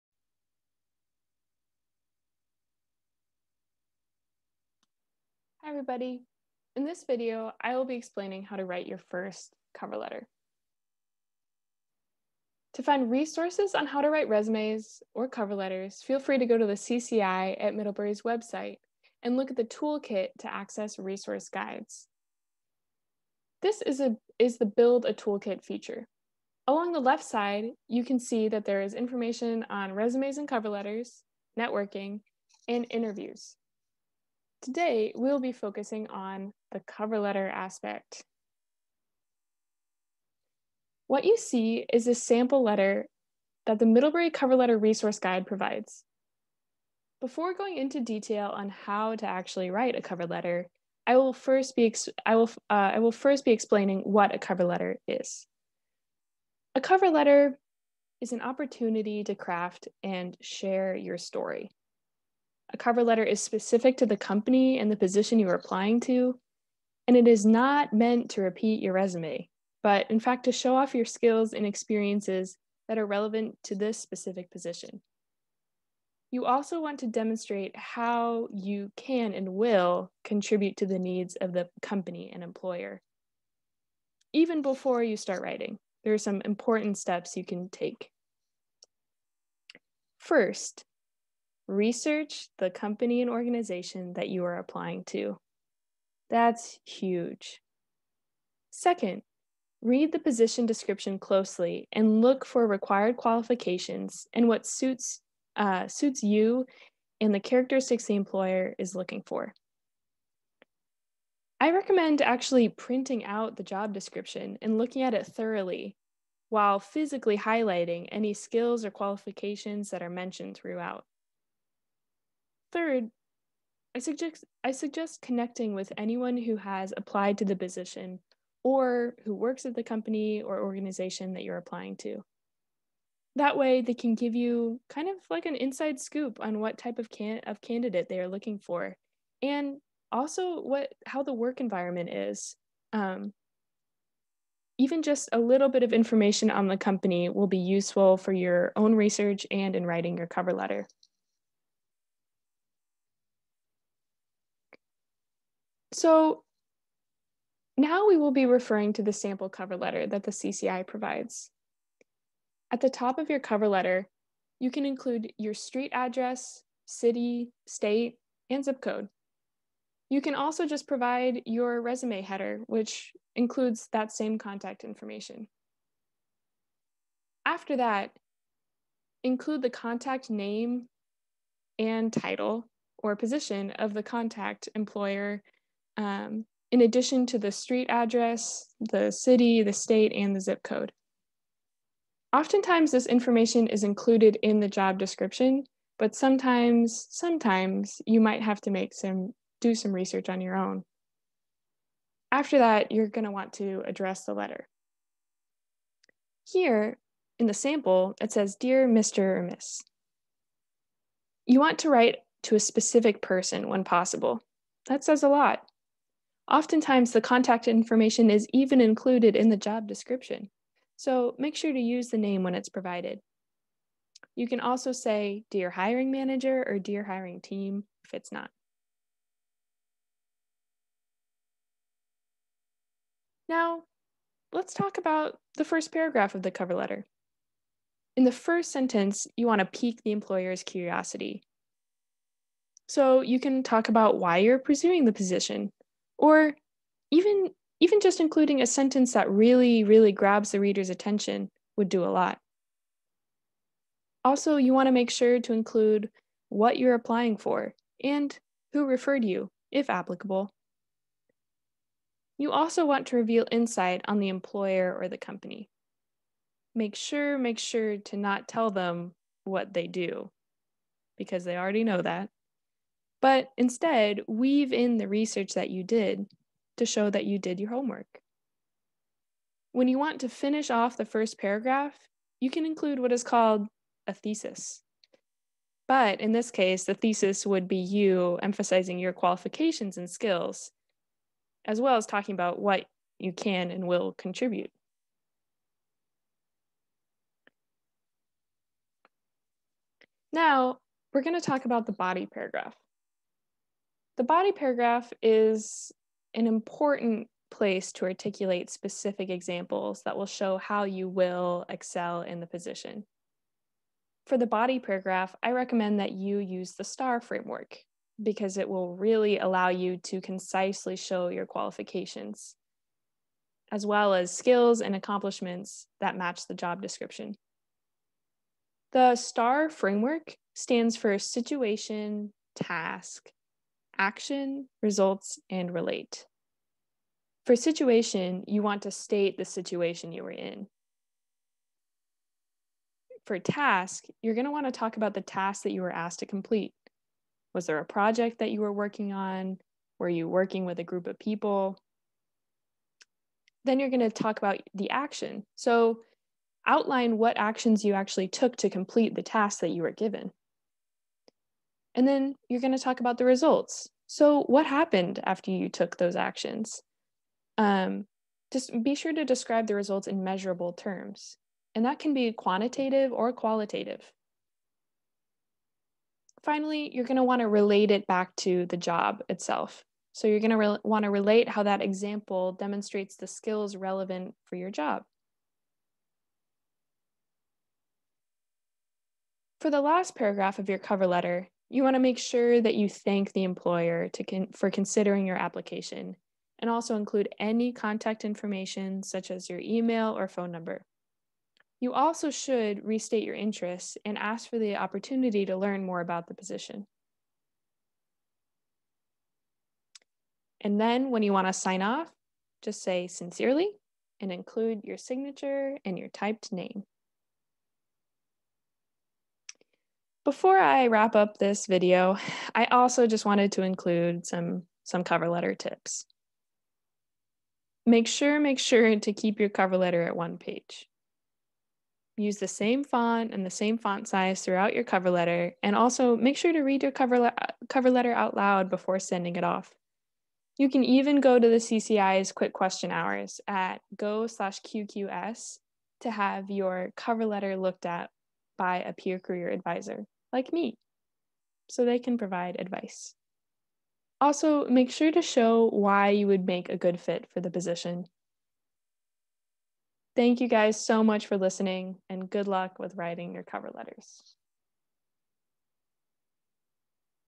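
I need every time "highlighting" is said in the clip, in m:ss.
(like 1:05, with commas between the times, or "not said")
1:57.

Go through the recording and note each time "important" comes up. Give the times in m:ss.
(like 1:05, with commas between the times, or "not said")
1:26, 5:06.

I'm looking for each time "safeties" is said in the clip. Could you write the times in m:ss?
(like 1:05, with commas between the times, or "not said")
not said.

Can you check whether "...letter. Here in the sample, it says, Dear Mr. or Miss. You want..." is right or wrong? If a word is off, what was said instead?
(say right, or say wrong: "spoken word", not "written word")
right.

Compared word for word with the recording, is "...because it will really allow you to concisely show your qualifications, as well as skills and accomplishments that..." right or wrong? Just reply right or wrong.
right.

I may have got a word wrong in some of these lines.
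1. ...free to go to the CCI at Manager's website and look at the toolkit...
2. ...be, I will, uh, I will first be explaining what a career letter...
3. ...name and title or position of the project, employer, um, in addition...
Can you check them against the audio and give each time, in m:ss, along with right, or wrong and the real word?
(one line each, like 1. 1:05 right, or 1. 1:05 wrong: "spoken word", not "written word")
1. 0:16 wrong: "Middlebury", not "Manager"
2. 0:51 wrong: "cover", not "career"
3. 3:00 wrong: "contact", not "project".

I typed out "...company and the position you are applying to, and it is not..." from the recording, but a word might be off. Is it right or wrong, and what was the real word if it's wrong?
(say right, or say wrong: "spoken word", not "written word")
right.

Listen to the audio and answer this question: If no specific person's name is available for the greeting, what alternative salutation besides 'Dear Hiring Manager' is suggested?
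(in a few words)
Dear Hiring Team.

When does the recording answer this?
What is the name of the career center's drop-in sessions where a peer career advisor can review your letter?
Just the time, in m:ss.
7:22.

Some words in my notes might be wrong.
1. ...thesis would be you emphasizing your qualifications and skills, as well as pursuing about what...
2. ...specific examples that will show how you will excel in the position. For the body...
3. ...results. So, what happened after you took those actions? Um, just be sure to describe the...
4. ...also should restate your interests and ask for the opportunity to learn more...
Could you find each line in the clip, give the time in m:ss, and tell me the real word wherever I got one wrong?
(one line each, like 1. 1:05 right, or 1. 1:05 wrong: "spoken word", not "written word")
1. 4:46 wrong: "talking", not "pursuing"
2. 5:08 right
3. 6:03 right
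4. 6:41 right.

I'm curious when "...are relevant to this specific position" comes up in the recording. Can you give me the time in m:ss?
1:12.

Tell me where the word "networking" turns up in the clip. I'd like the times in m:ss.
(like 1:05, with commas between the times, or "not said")
0:31.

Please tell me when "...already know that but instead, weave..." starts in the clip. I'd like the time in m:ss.
4:31.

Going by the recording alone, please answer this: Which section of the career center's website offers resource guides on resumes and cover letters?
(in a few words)
Build a Toolkit.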